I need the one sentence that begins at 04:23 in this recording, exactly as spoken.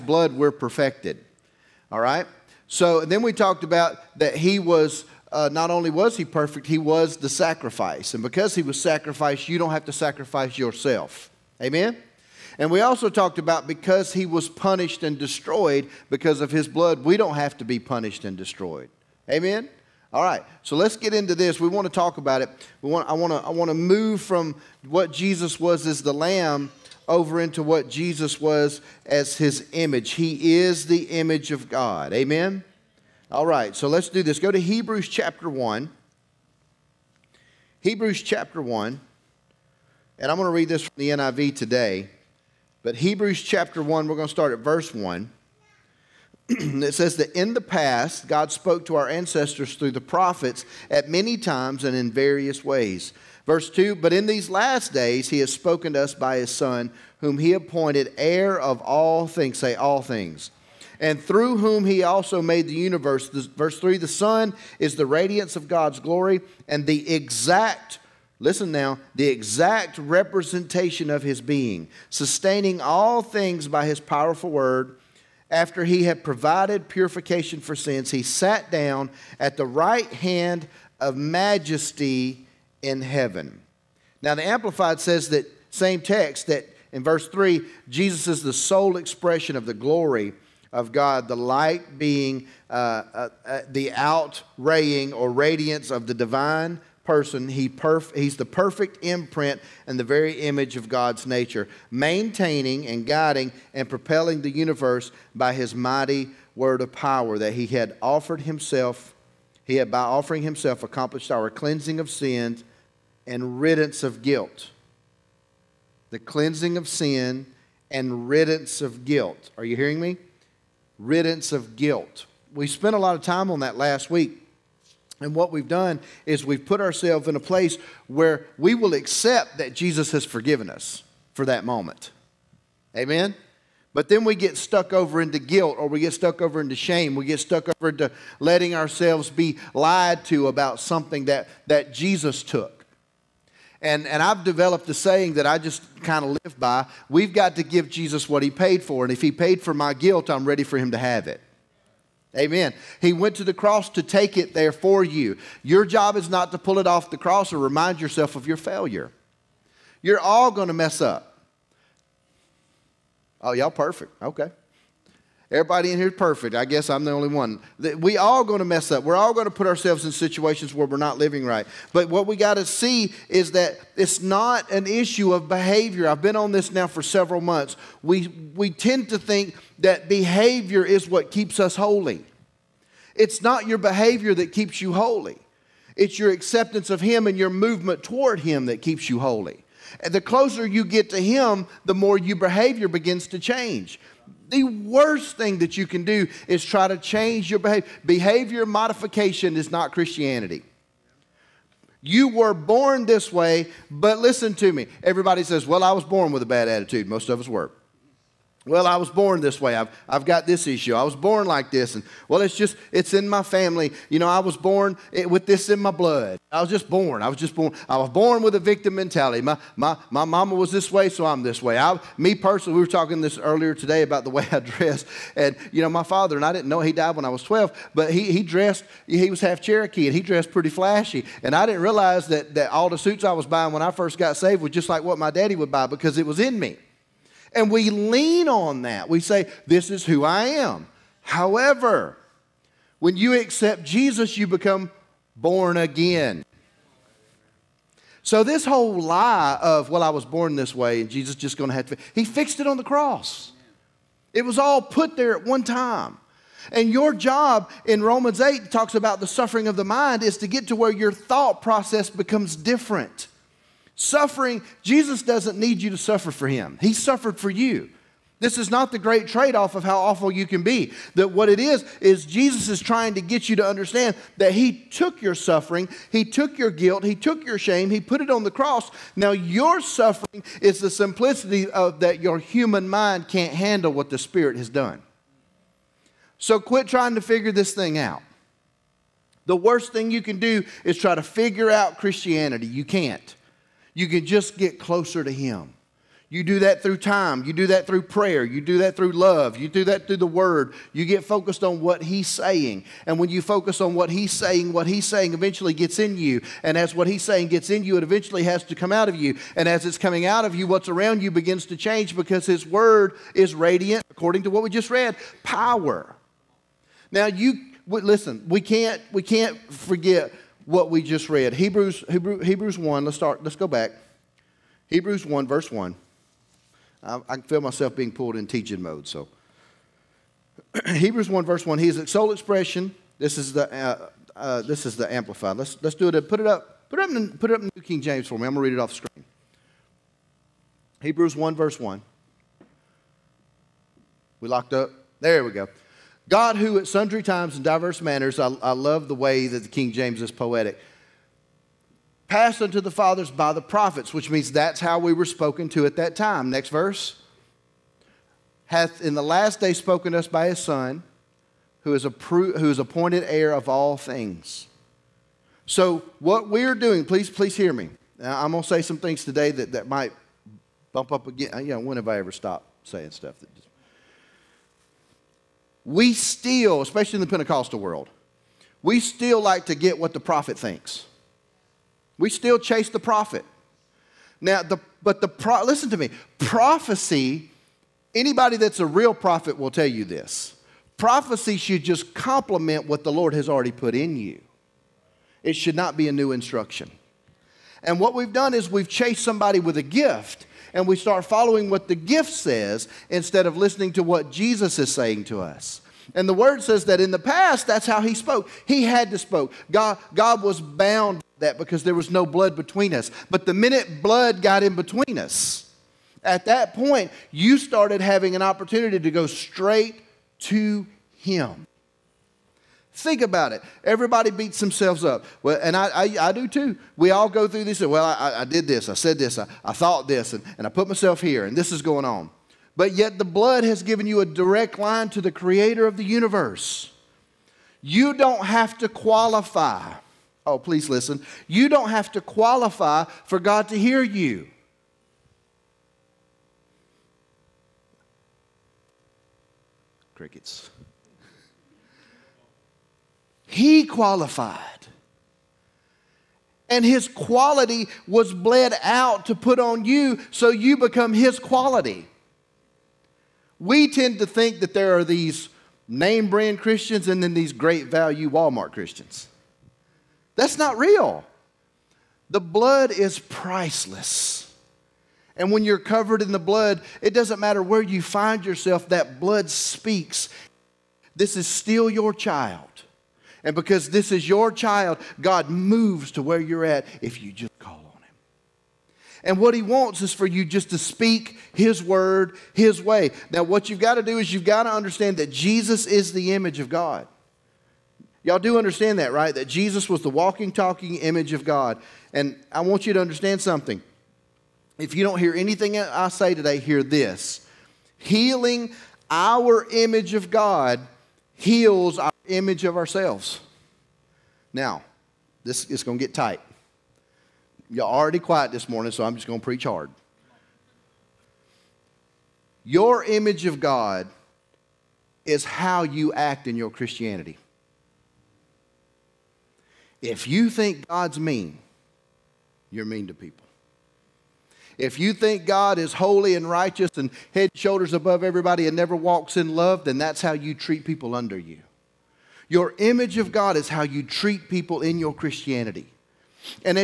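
Suffering, Jesus doesn't need you to suffer for him.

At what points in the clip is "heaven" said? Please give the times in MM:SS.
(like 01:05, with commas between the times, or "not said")
01:23.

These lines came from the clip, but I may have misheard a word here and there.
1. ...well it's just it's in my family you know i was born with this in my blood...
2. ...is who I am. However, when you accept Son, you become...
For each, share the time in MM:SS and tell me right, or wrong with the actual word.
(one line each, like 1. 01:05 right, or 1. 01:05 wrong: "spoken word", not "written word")
1. 03:32 right
2. 03:59 wrong: "Jesus", not "Son".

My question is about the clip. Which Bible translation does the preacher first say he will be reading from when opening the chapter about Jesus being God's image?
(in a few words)
NIV.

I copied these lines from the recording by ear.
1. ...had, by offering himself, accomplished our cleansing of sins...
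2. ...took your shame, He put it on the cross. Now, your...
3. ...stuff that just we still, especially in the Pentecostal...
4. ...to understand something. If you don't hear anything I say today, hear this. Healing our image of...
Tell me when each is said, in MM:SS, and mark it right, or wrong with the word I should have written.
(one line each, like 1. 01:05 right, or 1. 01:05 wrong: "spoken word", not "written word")
1. 01:49 right
2. 04:37 right
3. 06:13 right
4. 08:22 right.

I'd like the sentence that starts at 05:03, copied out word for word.
And when you focus on what he's saying, what he's saying eventually gets in you.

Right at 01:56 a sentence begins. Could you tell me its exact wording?
The cleansing of sin and riddance of guilt.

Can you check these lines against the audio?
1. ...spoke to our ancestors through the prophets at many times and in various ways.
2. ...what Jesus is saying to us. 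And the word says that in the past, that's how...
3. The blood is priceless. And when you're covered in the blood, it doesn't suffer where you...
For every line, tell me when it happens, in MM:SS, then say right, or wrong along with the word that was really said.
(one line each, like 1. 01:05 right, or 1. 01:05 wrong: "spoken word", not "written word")
1. 00:48 right
2. 06:44 right
3. 07:52 wrong: "matter", not "suffer".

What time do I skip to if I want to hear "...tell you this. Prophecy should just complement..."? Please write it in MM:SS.
06:29.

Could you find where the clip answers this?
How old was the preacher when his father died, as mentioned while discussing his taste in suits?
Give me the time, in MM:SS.
03:47.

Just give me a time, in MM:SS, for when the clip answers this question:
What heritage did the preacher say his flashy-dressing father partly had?
03:49.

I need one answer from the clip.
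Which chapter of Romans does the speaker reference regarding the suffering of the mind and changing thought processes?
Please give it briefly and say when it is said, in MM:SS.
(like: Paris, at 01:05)
Romans 8, at 04:18.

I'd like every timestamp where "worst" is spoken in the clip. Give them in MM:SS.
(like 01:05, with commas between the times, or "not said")
03:14, 04:49.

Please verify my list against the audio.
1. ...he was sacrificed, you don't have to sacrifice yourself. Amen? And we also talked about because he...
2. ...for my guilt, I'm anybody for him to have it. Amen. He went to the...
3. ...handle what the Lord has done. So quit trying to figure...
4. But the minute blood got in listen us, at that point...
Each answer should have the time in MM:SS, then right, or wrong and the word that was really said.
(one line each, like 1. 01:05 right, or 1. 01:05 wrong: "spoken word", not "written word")
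1. 00:08 right
2. 02:29 wrong: "ready", not "anybody"
3. 04:43 wrong: "Spirit", not "Lord"
4. 06:53 wrong: "between", not "listen".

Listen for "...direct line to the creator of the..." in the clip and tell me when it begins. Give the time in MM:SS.
07:14.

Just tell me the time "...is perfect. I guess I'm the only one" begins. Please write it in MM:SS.
02:46.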